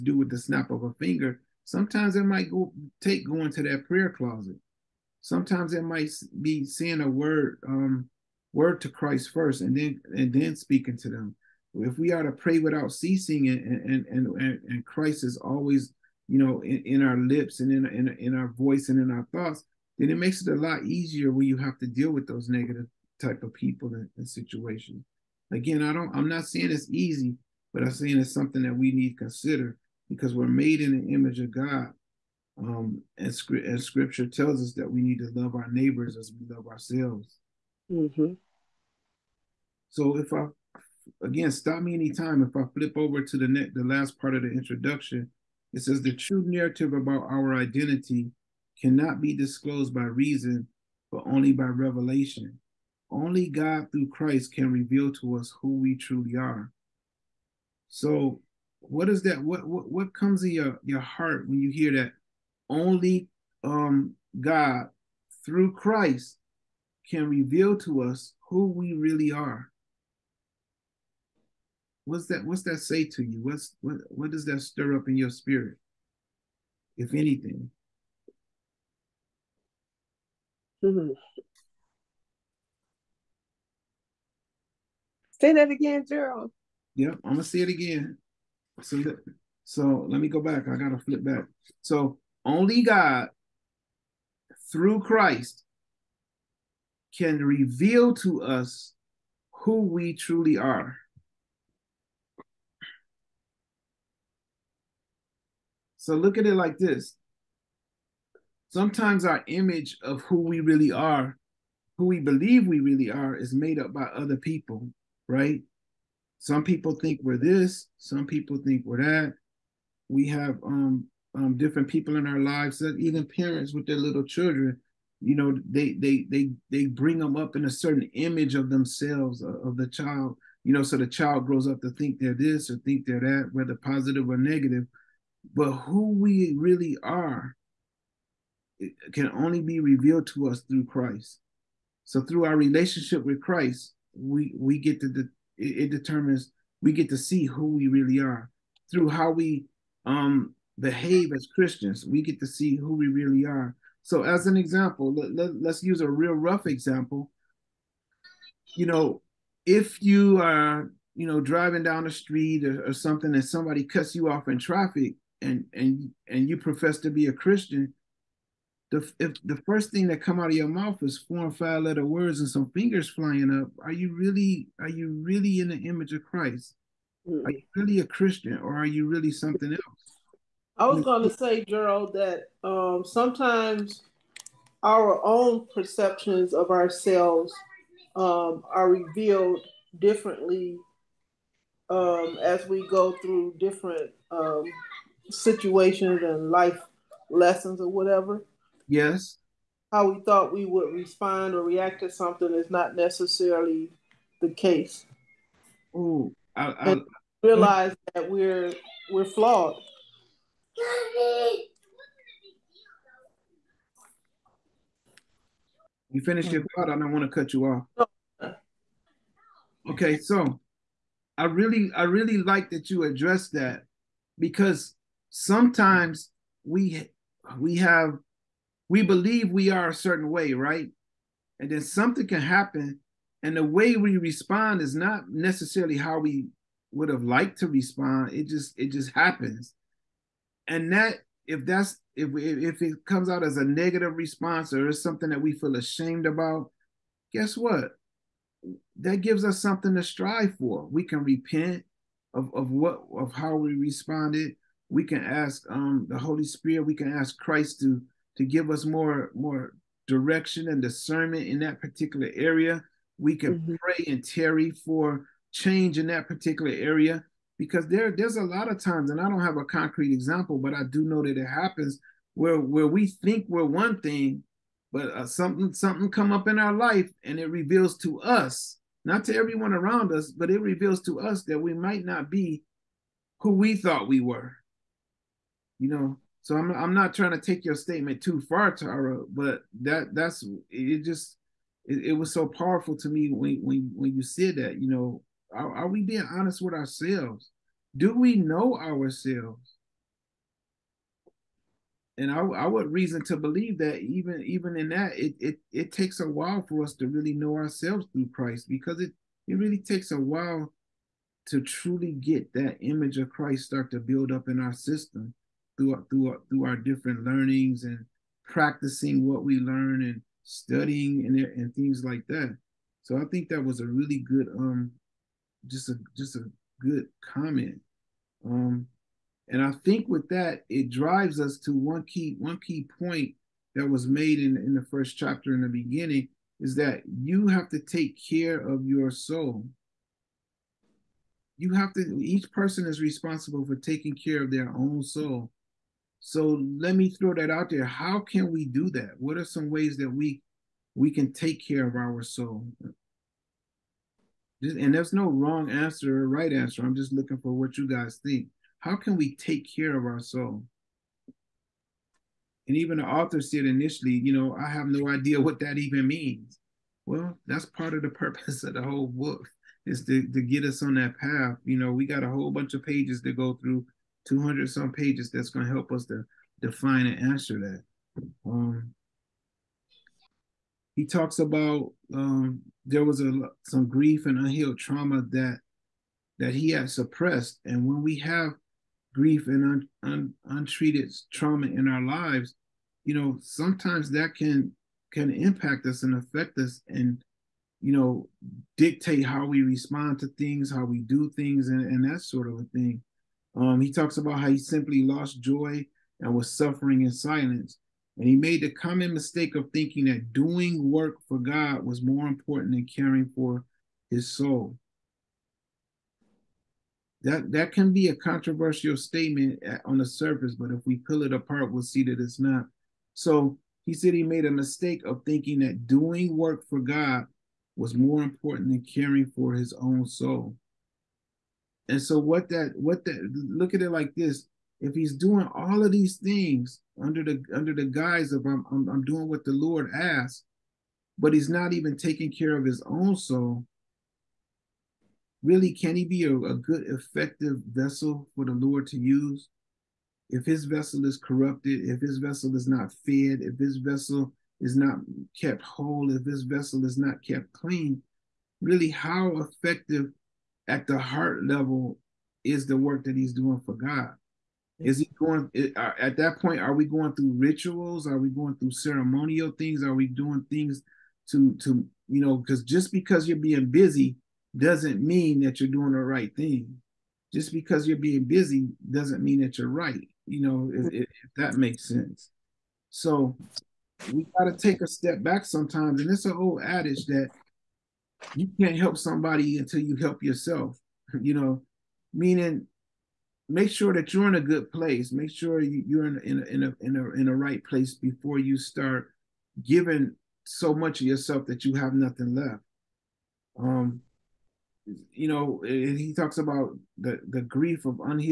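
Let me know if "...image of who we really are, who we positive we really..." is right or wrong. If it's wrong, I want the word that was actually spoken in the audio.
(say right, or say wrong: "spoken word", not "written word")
wrong: "believe", not "positive".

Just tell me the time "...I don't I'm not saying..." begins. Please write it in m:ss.
0:25.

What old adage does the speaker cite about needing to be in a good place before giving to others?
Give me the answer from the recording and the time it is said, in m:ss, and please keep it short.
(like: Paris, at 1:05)
You can't help somebody until you help yourself, at 8:08.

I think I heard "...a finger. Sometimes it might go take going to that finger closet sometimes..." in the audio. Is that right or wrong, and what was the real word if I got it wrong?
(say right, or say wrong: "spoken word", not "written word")
wrong: "prayer", not "finger".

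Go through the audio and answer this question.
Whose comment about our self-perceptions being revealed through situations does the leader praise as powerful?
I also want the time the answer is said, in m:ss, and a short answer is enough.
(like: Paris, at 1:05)
Tara, at 4:48.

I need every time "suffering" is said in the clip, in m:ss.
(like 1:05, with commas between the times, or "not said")
6:46.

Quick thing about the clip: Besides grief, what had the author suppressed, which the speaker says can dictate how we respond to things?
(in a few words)
Unhealed trauma.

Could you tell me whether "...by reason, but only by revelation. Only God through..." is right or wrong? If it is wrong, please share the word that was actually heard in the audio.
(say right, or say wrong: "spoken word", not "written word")
right.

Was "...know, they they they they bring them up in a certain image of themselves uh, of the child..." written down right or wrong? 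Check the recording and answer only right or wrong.
right.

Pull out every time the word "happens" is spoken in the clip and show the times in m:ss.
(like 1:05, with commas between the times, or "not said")
3:52, 3:59, 4:31.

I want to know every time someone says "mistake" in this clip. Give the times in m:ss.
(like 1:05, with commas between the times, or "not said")
6:49, 7:04.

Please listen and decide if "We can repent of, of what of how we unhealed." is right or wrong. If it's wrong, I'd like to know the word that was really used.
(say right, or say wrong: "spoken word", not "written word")
wrong: "responded", not "unhealed".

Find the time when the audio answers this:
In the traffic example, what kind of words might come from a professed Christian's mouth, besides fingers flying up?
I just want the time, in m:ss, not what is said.
2:51.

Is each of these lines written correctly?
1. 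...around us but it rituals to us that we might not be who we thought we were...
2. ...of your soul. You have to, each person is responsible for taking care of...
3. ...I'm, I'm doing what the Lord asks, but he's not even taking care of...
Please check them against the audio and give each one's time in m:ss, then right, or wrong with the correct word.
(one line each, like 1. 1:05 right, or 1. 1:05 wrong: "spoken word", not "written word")
1. 4:39 wrong: "reveals", not "rituals"
2. 5:38 right
3. 7:18 right.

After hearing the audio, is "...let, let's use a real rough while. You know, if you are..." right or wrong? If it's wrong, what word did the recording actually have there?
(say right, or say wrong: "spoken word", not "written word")
wrong: "example", not "while".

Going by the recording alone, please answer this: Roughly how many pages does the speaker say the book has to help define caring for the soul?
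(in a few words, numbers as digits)
200 some.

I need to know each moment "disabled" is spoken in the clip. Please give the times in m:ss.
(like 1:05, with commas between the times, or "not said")
not said.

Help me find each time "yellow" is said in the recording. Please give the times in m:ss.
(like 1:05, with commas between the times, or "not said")
not said.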